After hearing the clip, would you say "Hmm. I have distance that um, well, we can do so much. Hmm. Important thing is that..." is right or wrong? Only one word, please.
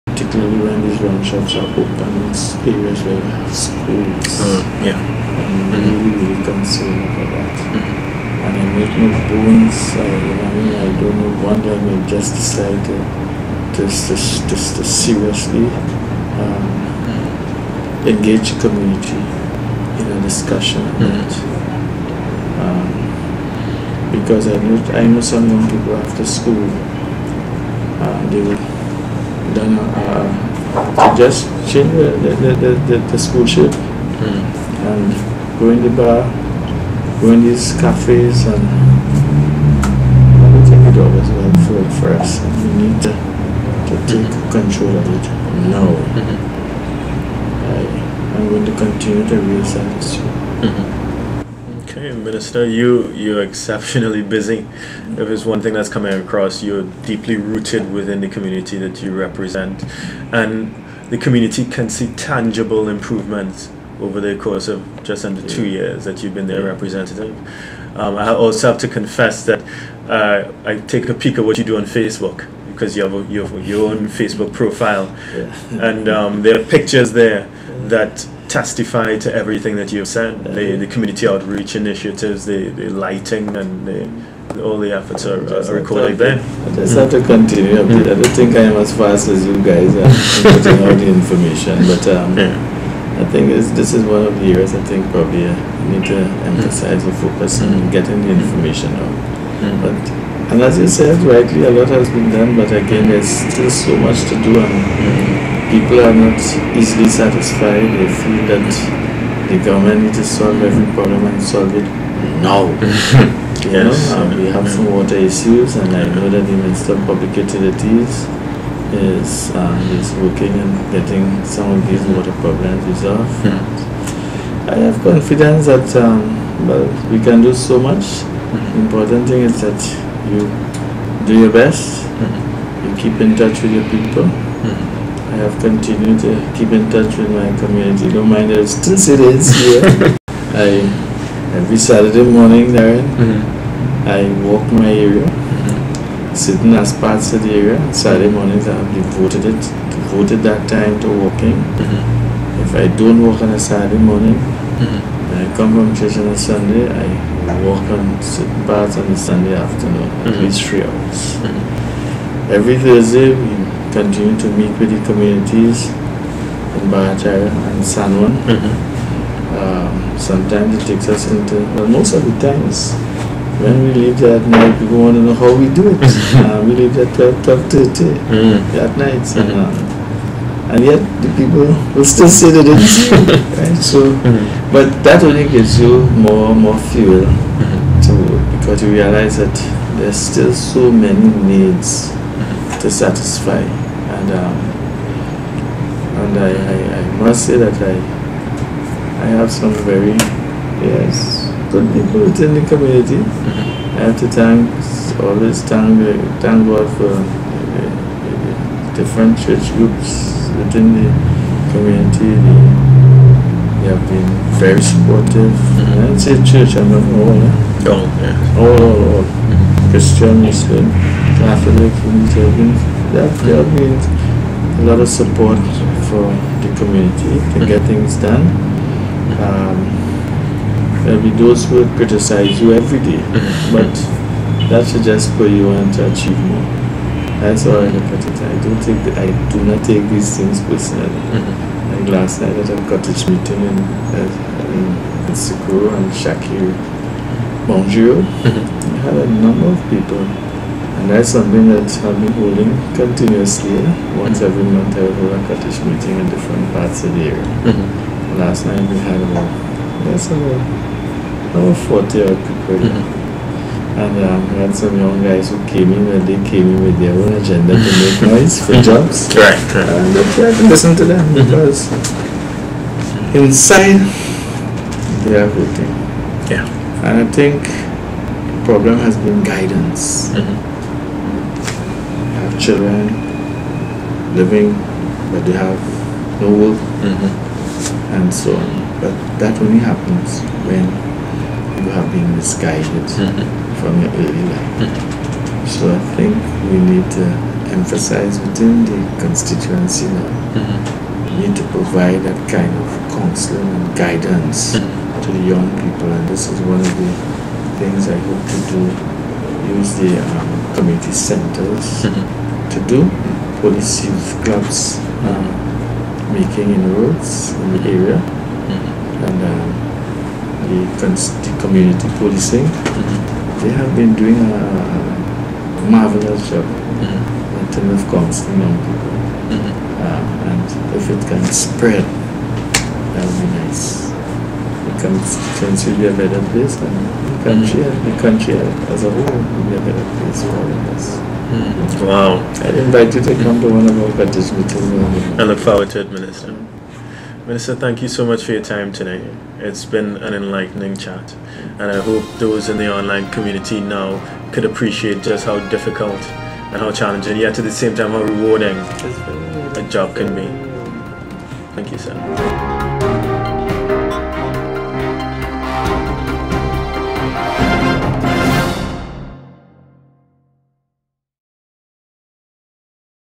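wrong.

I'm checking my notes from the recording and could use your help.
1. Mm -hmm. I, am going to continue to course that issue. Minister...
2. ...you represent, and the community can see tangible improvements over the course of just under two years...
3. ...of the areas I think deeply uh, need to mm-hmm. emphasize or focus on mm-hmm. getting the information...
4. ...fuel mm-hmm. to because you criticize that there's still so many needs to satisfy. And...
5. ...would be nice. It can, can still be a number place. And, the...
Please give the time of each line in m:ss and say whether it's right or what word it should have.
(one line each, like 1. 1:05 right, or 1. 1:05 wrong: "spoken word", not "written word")
1. 0:45 wrong: "raise", not "course"
2. 0:59 right
3. 1:34 wrong: "probably", not "deeply"
4. 3:06 wrong: "realize", not "criticize"
5. 5:33 wrong: "better", not "number".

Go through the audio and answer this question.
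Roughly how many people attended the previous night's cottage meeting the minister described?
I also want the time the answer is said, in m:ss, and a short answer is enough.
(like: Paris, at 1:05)
40, at 4:21.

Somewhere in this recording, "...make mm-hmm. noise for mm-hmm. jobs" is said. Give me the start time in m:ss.
4:27.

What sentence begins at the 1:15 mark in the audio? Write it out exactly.
and um, there are pictures there that testify to everything that you've said.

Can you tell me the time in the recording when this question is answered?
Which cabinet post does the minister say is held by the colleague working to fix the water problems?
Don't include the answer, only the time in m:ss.
1:56.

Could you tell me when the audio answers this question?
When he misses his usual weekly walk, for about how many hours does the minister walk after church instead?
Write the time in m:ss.
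2:40.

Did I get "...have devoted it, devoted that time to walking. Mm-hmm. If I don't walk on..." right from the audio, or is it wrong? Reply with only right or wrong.
right.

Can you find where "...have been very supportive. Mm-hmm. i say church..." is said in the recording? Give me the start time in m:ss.
3:33.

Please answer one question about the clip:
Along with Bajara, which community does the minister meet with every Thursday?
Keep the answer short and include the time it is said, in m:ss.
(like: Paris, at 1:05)
San Juan, at 2:47.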